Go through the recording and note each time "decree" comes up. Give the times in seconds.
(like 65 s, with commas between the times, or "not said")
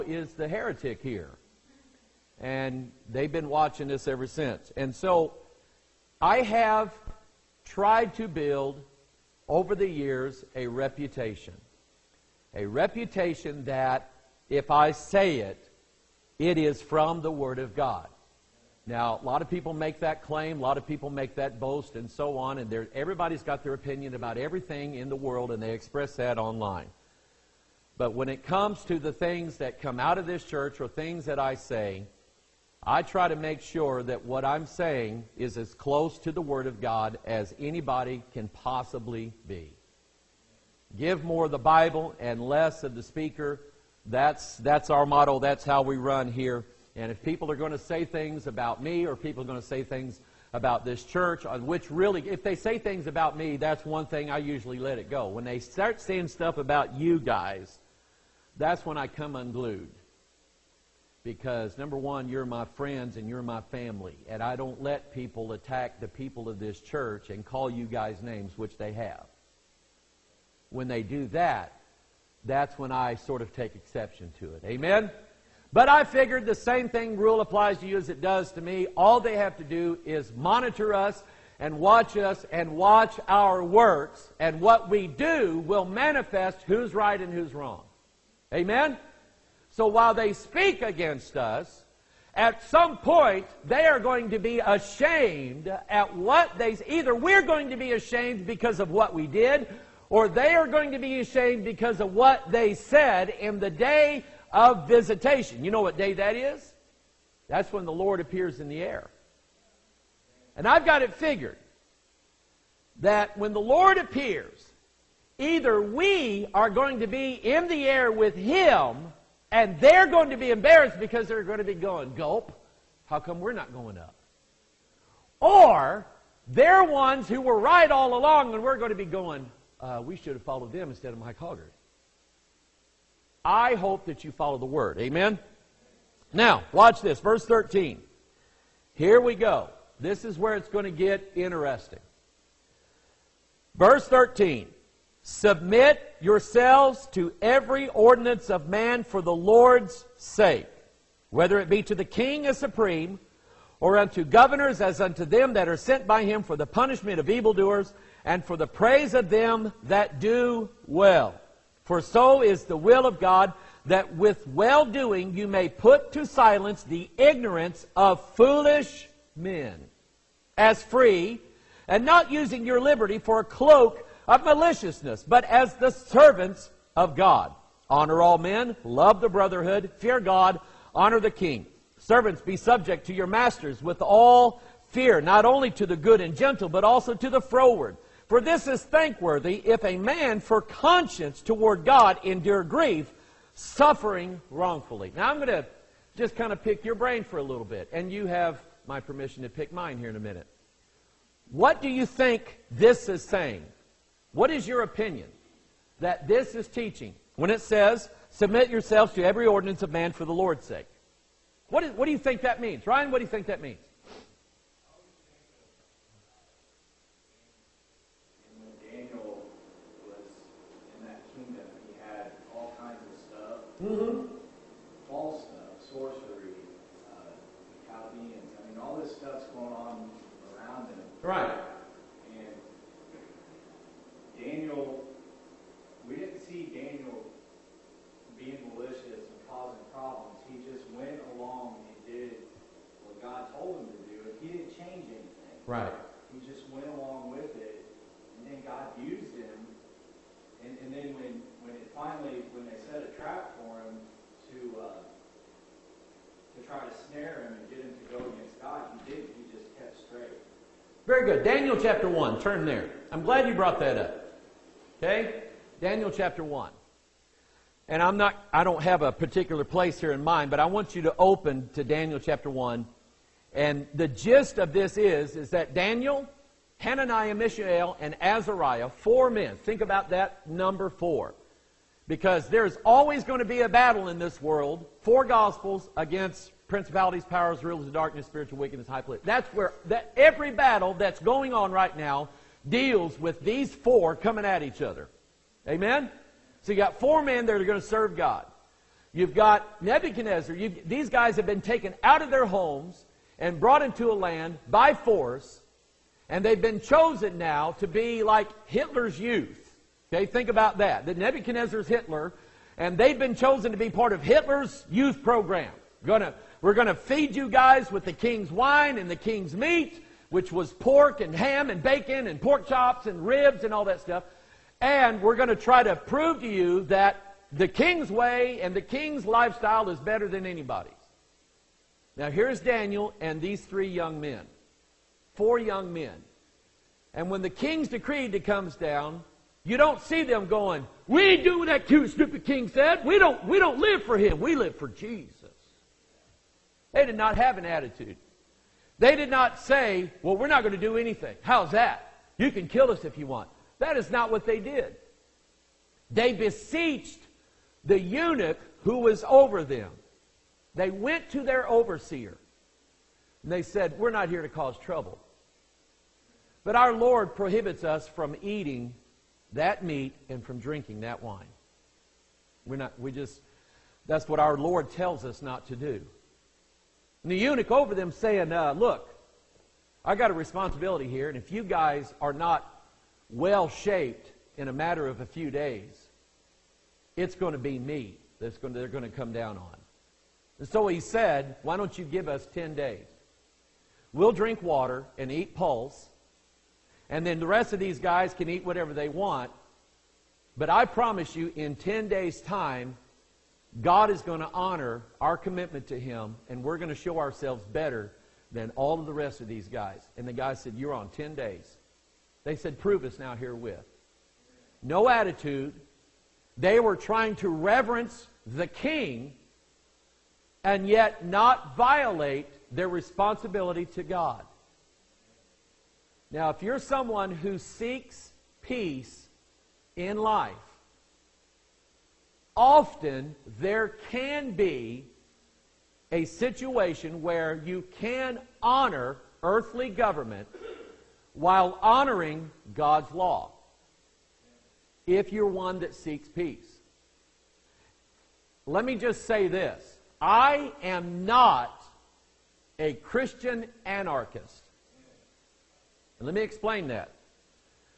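337 s.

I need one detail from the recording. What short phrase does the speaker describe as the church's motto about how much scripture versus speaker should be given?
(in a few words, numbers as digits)
Give more of the Bible and less of the speaker.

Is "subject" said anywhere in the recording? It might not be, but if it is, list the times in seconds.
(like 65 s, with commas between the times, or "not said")
182 s.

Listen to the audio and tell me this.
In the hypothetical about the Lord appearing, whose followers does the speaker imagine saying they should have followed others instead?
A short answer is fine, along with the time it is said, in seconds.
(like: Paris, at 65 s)
Mike Hoggard, at 131 s.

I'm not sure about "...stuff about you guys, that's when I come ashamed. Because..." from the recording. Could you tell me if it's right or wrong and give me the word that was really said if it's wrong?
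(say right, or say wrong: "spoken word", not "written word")
wrong: "unglued", not "ashamed".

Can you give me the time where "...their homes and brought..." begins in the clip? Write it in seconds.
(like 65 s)
302 s.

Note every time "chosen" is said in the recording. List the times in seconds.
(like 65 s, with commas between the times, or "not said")
306 s, 313 s.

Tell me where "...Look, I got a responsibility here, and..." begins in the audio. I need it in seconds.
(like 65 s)
378 s.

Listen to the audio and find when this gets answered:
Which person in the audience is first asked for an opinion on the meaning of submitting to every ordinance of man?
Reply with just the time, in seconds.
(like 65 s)
212 s.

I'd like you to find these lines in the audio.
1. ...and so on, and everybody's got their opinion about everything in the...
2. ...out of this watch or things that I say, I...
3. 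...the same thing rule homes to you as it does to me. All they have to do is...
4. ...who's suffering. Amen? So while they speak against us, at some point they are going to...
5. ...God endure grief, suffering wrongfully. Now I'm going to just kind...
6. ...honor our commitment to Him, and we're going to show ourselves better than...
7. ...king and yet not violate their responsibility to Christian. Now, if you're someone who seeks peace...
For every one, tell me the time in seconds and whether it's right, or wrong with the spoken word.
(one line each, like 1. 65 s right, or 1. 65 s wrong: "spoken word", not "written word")
1. 21 s right
2. 30 s wrong: "church", not "watch"
3. 76 s wrong: "applies", not "homes"
4. 87 s wrong: "wrong", not "suffering"
5. 191 s right
6. 404 s right
7. 418 s wrong: "God", not "Christian".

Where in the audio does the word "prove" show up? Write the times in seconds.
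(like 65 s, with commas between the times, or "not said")
325 s, 412 s.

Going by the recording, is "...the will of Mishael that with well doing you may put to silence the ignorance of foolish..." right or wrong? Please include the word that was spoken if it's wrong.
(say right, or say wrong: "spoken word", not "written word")
wrong: "God", not "Mishael".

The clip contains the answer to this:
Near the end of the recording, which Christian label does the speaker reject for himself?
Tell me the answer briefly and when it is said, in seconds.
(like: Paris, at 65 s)
Christian anarchist, at 452 s.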